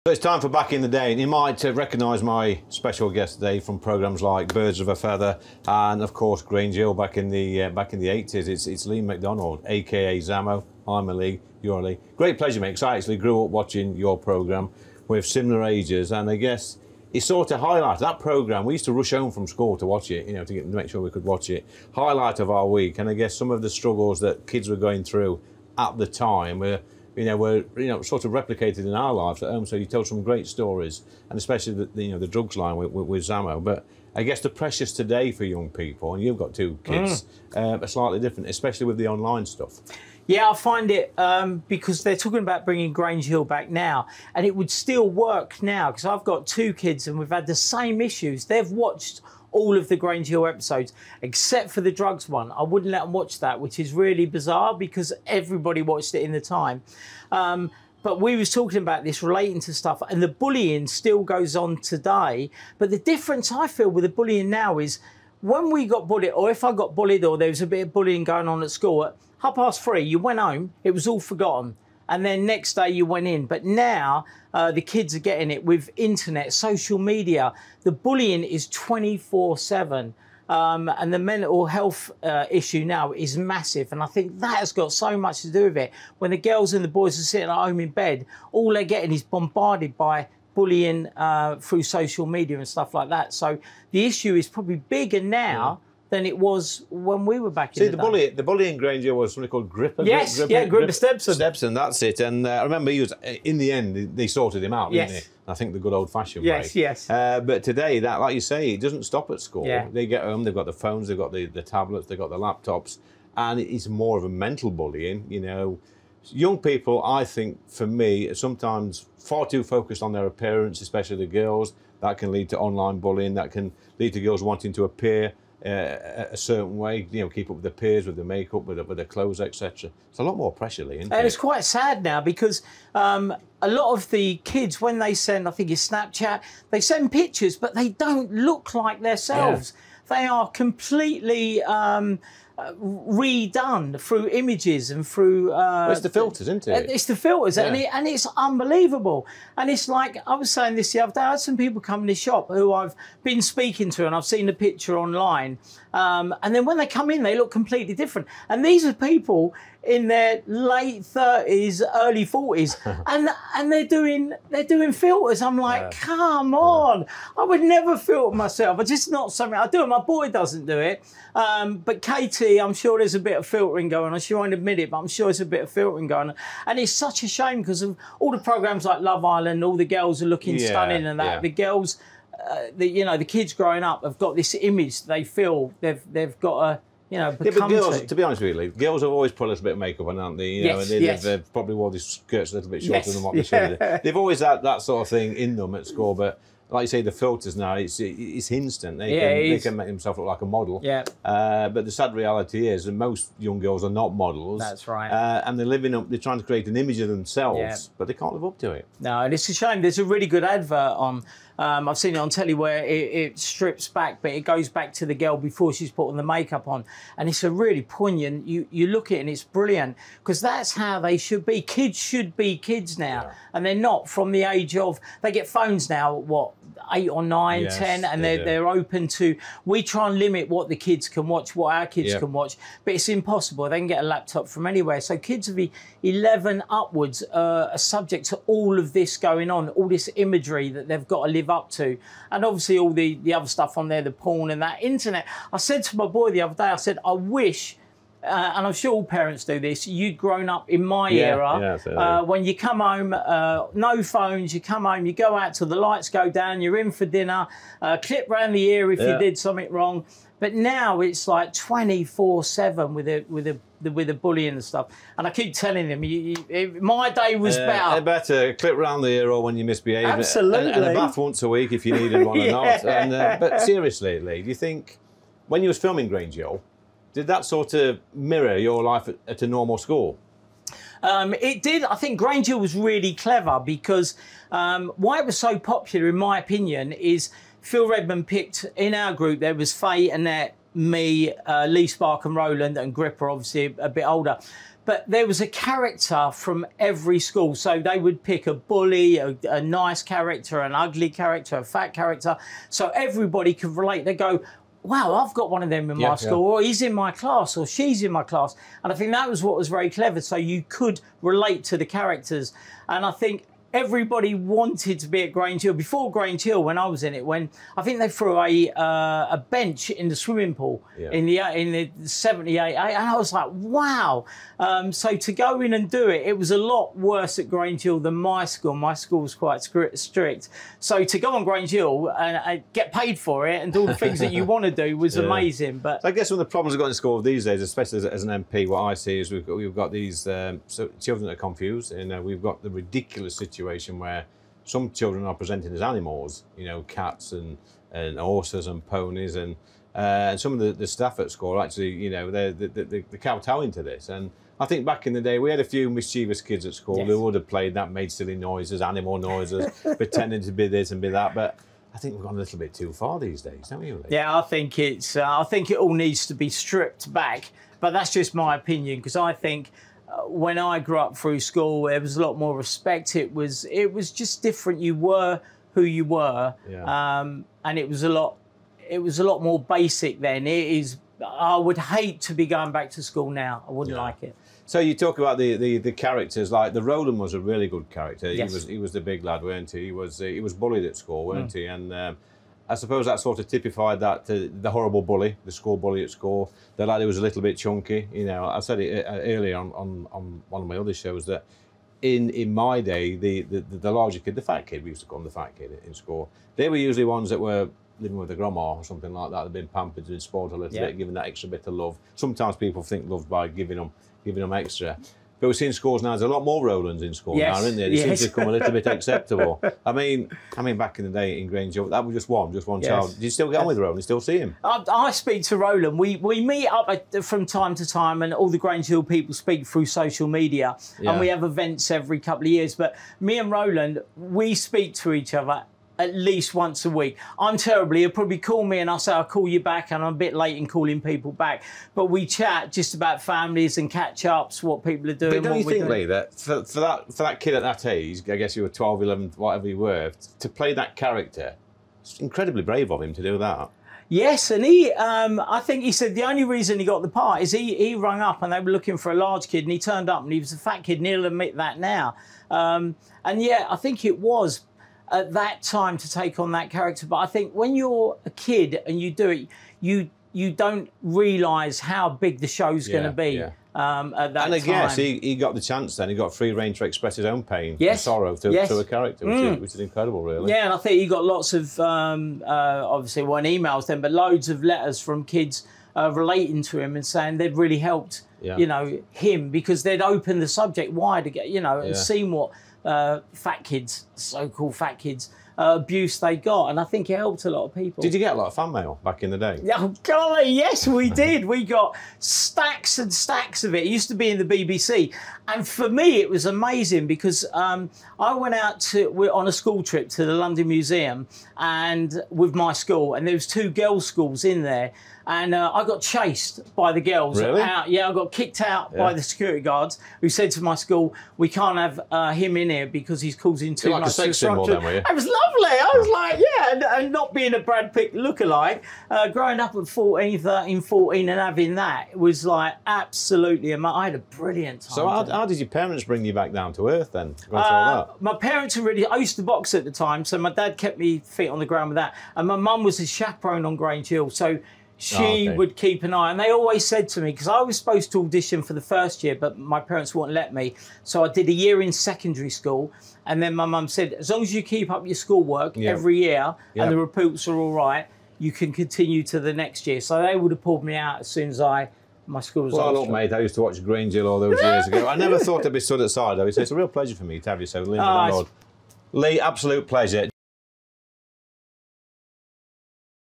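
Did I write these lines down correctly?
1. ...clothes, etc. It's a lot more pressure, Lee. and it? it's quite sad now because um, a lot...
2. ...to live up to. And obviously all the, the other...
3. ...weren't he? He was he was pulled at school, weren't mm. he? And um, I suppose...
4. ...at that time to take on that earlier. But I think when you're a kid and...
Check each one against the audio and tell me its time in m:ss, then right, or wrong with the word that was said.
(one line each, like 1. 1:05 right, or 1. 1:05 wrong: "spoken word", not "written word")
1. 2:09 right
2. 4:01 right
3. 6:29 wrong: "bullied", not "pulled"
4. 7:45 wrong: "character", not "earlier".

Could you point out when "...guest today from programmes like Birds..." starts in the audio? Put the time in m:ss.
0:03.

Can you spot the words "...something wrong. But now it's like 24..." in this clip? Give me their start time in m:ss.
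4:19.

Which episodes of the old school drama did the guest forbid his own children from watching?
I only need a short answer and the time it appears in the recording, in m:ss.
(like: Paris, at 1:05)
The drugs one, at 0:51.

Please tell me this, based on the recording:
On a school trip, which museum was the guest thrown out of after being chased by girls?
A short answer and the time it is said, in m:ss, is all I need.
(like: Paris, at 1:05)
The London Museum, at 8:30.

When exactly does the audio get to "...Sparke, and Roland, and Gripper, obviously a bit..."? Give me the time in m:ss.
4:51.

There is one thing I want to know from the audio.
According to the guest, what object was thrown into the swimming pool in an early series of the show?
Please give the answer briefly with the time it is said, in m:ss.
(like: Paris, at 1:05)
A bench, at 5:19.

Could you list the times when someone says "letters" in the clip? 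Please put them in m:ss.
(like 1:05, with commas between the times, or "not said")
8:04.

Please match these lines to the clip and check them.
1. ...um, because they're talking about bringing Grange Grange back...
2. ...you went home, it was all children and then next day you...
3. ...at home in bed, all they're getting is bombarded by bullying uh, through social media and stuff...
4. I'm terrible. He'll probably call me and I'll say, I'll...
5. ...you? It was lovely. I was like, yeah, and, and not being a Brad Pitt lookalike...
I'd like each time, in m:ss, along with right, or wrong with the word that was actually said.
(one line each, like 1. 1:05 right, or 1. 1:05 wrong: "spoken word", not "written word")
1. 0:41 wrong: "Hill", not "Grange"
2. 1:10 wrong: "forgotten", not "children"
3. 1:27 right
4. 7:17 right
5. 8:44 right.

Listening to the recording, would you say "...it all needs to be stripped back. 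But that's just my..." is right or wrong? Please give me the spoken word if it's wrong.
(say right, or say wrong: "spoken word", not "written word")
right.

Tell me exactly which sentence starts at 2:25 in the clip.
Uh, well, it's the filters, isn't it?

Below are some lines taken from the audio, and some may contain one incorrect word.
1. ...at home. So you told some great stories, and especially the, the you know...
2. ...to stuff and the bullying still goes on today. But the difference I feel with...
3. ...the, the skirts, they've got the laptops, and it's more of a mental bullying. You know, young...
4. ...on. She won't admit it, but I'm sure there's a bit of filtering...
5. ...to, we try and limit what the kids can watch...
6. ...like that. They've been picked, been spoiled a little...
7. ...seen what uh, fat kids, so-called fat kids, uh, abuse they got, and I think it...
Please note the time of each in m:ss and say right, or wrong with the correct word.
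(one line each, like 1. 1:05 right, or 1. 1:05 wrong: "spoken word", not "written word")
1. 0:29 right
2. 0:59 right
3. 1:51 wrong: "tablets", not "skirts"
4. 2:54 right
5. 3:49 right
6. 6:49 wrong: "pampered", not "picked"
7. 8:11 right.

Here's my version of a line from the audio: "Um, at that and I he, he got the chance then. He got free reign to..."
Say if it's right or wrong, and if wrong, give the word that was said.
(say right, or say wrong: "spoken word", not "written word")
right.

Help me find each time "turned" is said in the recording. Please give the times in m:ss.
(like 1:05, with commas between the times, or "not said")
7:39.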